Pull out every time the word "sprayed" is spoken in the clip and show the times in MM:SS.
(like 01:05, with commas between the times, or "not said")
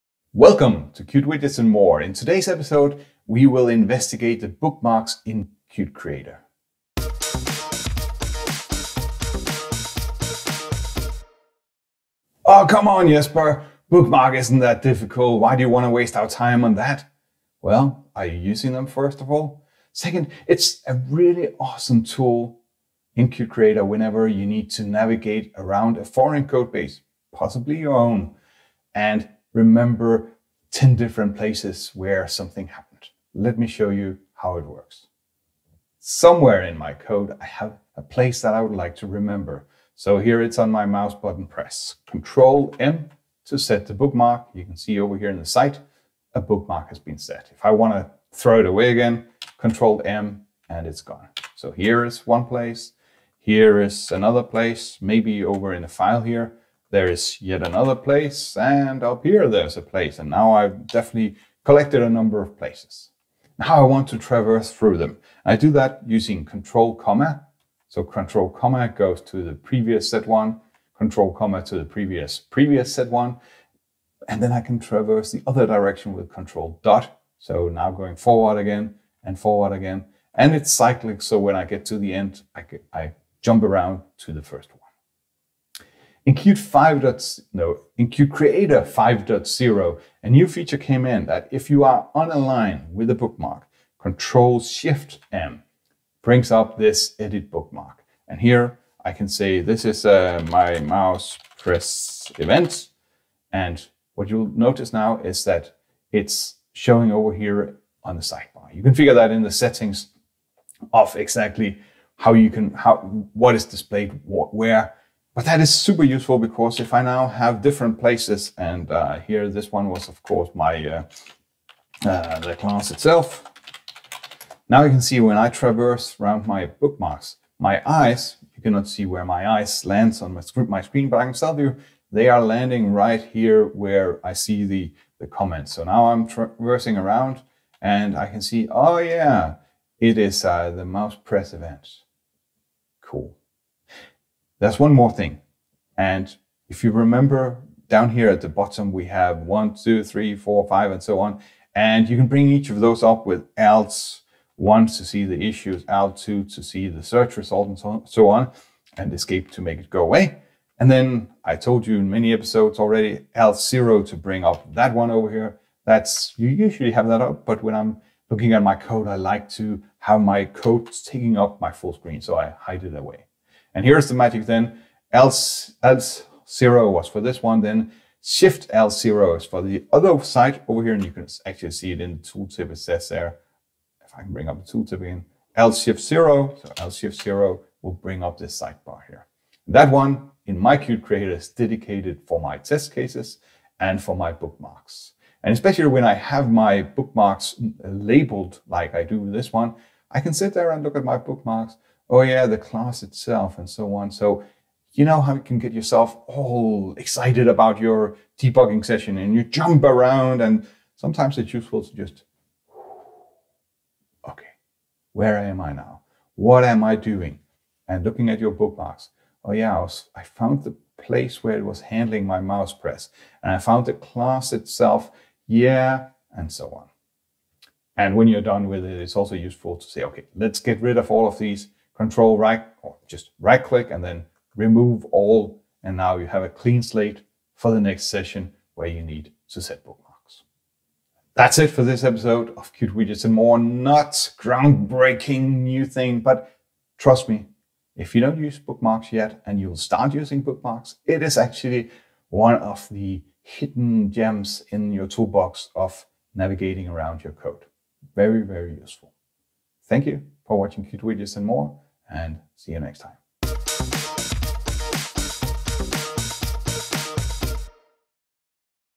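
not said.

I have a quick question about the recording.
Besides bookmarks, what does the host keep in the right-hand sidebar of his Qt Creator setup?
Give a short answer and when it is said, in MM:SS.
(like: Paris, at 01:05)
test cases, at 03:12.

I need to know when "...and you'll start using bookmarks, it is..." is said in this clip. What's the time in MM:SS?
04:09.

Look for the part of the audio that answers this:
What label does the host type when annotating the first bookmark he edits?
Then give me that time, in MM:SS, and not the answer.
01:40.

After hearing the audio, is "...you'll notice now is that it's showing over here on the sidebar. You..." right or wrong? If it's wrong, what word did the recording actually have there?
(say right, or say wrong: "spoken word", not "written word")
right.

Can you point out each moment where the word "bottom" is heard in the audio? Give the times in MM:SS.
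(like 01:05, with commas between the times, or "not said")
02:28.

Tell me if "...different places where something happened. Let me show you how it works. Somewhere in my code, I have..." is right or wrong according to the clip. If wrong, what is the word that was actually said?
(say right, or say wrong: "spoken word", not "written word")
right.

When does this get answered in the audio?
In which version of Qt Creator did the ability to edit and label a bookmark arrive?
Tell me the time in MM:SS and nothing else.
01:28.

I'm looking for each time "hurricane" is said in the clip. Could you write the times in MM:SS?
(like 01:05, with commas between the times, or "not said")
not said.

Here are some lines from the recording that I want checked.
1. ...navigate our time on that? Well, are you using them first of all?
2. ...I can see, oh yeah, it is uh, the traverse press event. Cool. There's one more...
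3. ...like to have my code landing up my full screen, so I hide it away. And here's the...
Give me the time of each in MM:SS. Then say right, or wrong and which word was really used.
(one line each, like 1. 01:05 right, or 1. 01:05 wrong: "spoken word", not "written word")
1. 00:15 wrong: "waste", not "navigate"
2. 02:18 wrong: "mouse", not "traverse"
3. 02:49 wrong: "taking", not "landing".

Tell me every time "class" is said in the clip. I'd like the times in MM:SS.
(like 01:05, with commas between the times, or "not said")
02:02, 03:22, 03:43.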